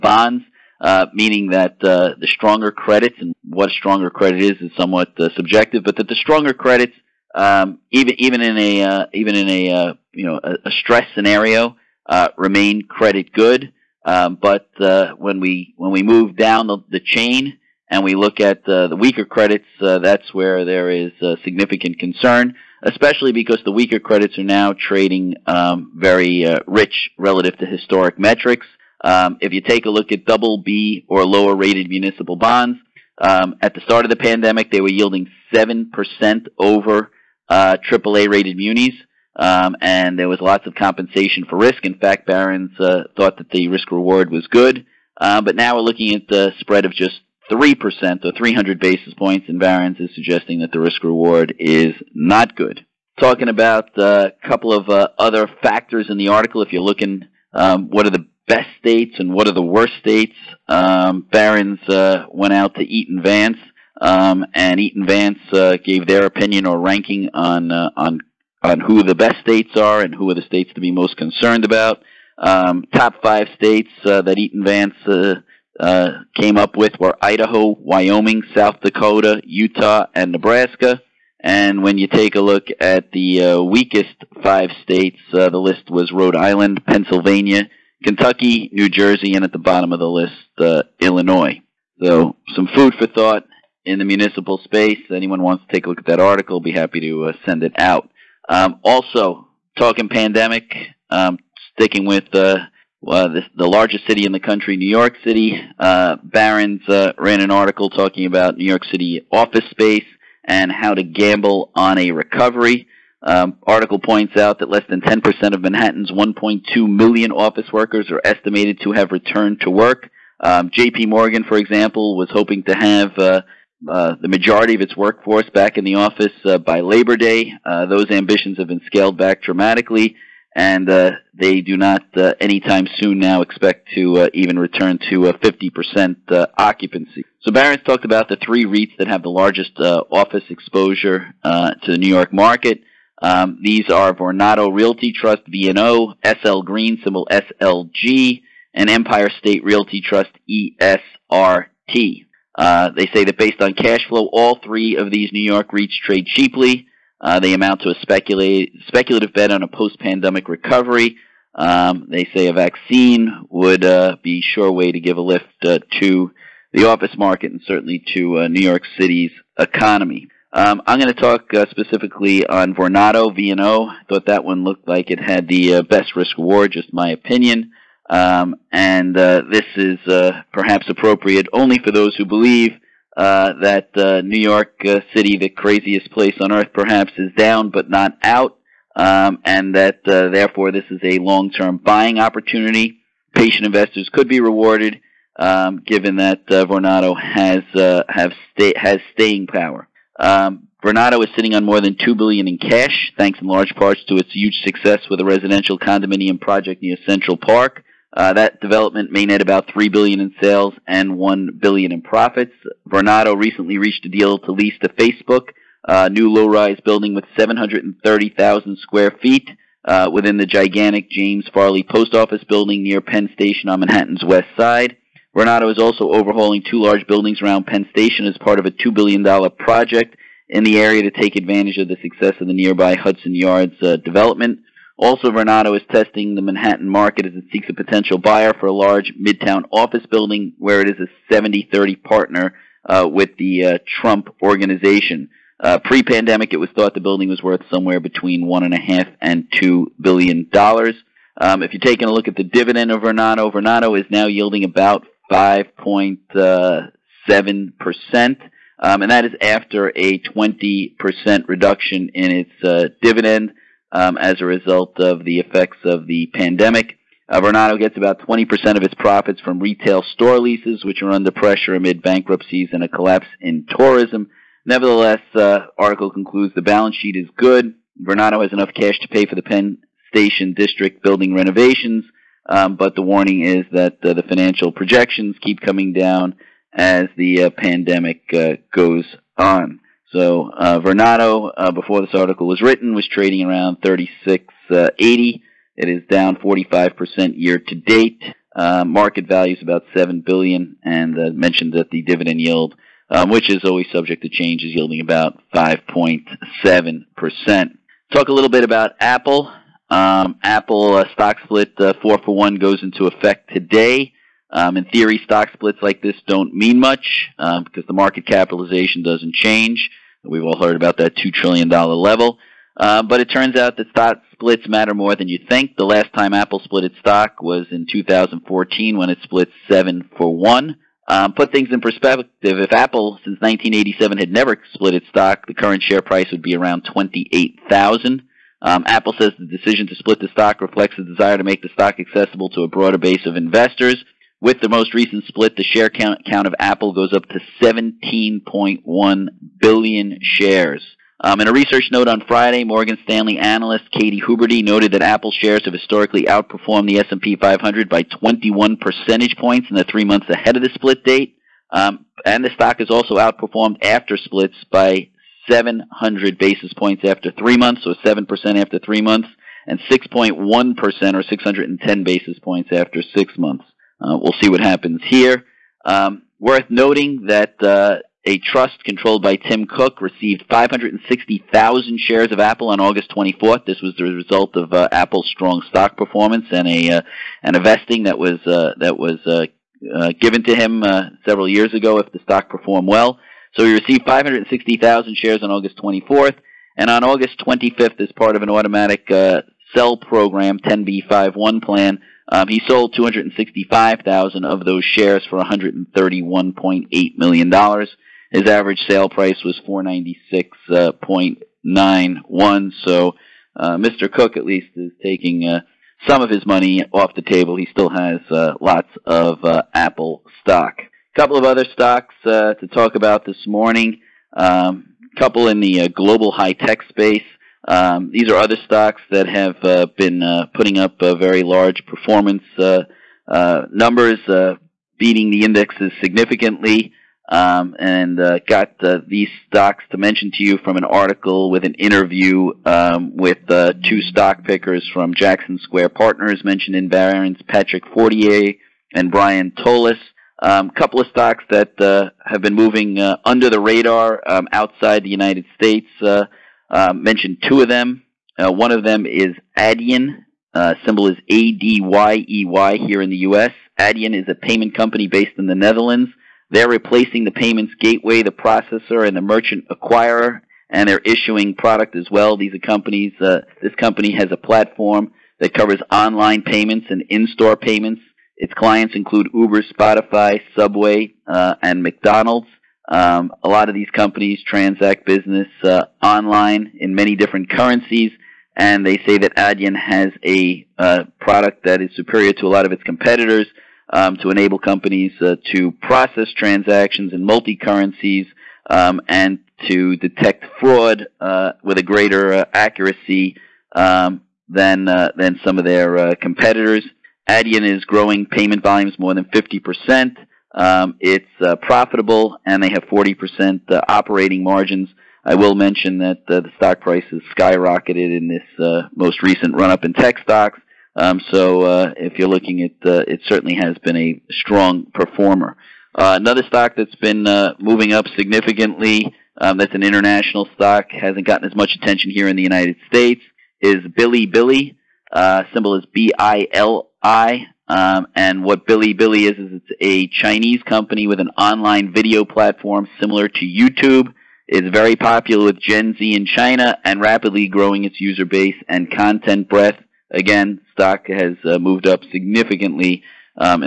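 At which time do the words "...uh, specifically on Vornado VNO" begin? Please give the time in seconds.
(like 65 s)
171 s.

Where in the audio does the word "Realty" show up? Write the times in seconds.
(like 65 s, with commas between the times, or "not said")
144 s, 149 s.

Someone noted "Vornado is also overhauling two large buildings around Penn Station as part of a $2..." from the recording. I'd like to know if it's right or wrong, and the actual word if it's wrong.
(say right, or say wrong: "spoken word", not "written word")
right.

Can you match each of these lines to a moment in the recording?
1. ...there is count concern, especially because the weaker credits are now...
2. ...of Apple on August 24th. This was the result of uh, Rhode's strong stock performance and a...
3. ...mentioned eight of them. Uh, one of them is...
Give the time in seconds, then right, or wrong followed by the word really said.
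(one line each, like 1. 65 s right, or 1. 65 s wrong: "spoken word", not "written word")
1. 20 s wrong: "significant", not "count"
2. 382 s wrong: "Apple", not "Rhode"
3. 456 s wrong: "two", not "eight".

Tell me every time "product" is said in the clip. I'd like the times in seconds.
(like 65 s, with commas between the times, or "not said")
471 s, 491 s.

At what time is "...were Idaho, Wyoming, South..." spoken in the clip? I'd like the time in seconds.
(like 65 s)
76 s.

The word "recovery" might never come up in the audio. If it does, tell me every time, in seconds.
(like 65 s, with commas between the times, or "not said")
112 s, 160 s.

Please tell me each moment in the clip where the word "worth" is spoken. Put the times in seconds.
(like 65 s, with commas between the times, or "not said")
247 s, 376 s.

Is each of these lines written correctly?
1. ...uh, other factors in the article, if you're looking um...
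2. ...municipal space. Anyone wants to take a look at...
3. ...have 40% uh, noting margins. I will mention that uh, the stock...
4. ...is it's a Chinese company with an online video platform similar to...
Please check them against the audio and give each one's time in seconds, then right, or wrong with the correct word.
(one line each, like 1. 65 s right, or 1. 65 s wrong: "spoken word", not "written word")
1. 54 s right
2. 94 s right
3. 512 s wrong: "operating", not "noting"
4. 539 s right.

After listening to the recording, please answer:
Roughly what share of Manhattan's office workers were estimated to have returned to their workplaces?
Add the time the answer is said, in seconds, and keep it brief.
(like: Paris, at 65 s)
less than 10%, at 114 s.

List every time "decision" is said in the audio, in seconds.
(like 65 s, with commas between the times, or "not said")
339 s.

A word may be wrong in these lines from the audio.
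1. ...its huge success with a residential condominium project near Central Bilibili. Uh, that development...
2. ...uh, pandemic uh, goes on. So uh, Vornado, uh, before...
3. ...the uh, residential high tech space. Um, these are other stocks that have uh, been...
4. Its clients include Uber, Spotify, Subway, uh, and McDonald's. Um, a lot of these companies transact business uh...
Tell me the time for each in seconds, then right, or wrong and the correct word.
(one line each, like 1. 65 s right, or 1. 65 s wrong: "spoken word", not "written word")
1. 204 s wrong: "Park", not "Bilibili"
2. 287 s right
3. 425 s wrong: "global", not "residential"
4. 478 s right.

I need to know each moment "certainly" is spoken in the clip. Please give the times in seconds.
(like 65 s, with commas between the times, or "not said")
167 s, 523 s.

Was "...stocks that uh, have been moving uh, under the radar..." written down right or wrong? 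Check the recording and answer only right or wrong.
right.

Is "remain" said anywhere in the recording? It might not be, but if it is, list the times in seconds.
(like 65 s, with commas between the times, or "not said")
12 s.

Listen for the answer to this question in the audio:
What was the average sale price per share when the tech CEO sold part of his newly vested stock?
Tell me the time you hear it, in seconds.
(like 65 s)
409 s.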